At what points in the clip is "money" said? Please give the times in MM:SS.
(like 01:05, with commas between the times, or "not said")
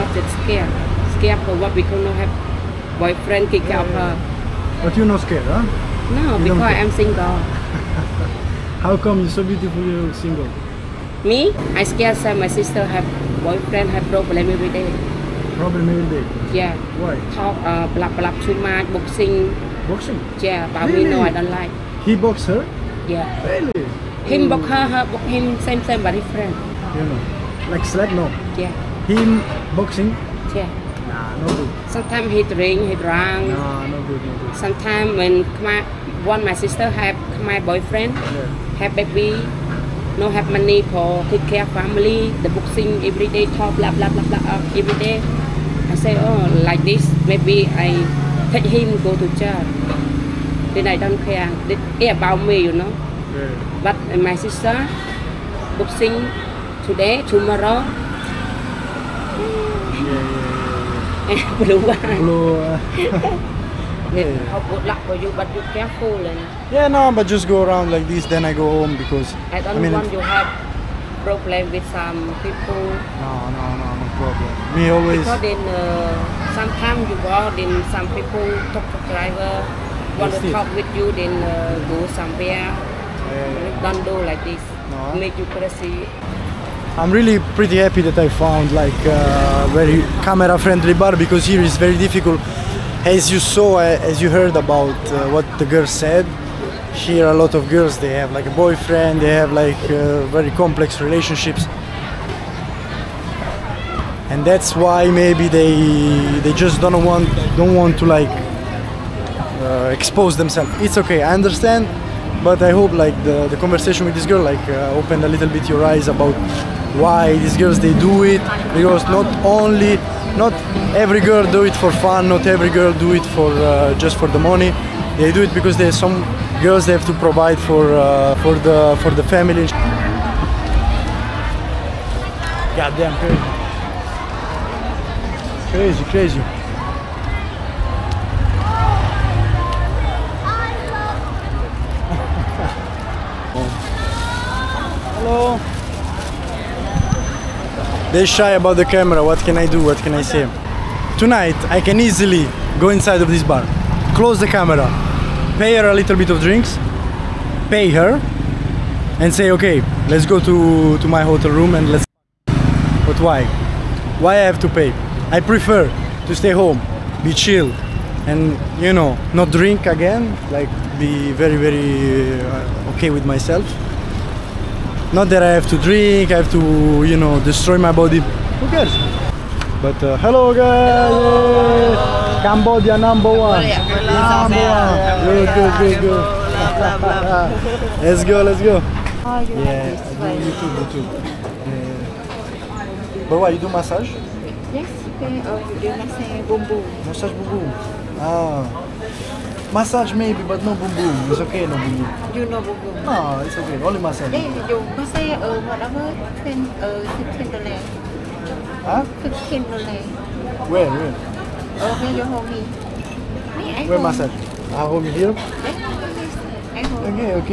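00:40, 02:04.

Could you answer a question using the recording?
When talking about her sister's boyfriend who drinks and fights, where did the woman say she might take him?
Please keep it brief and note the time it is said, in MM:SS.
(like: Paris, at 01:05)
church, at 00:49.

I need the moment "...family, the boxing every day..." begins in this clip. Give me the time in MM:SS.
00:41.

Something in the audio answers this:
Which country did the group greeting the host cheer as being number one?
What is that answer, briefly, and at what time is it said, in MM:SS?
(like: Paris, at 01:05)
Cambodia, at 03:02.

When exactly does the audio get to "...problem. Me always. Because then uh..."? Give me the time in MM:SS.
01:14.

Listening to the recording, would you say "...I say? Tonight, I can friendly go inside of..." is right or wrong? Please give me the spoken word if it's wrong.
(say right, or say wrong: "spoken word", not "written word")
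wrong: "easily", not "friendly".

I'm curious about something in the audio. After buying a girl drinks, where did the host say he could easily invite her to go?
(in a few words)
my hotel room.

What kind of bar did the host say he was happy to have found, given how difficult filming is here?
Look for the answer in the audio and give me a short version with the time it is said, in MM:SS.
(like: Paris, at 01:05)
camera friendly bar, at 01:30.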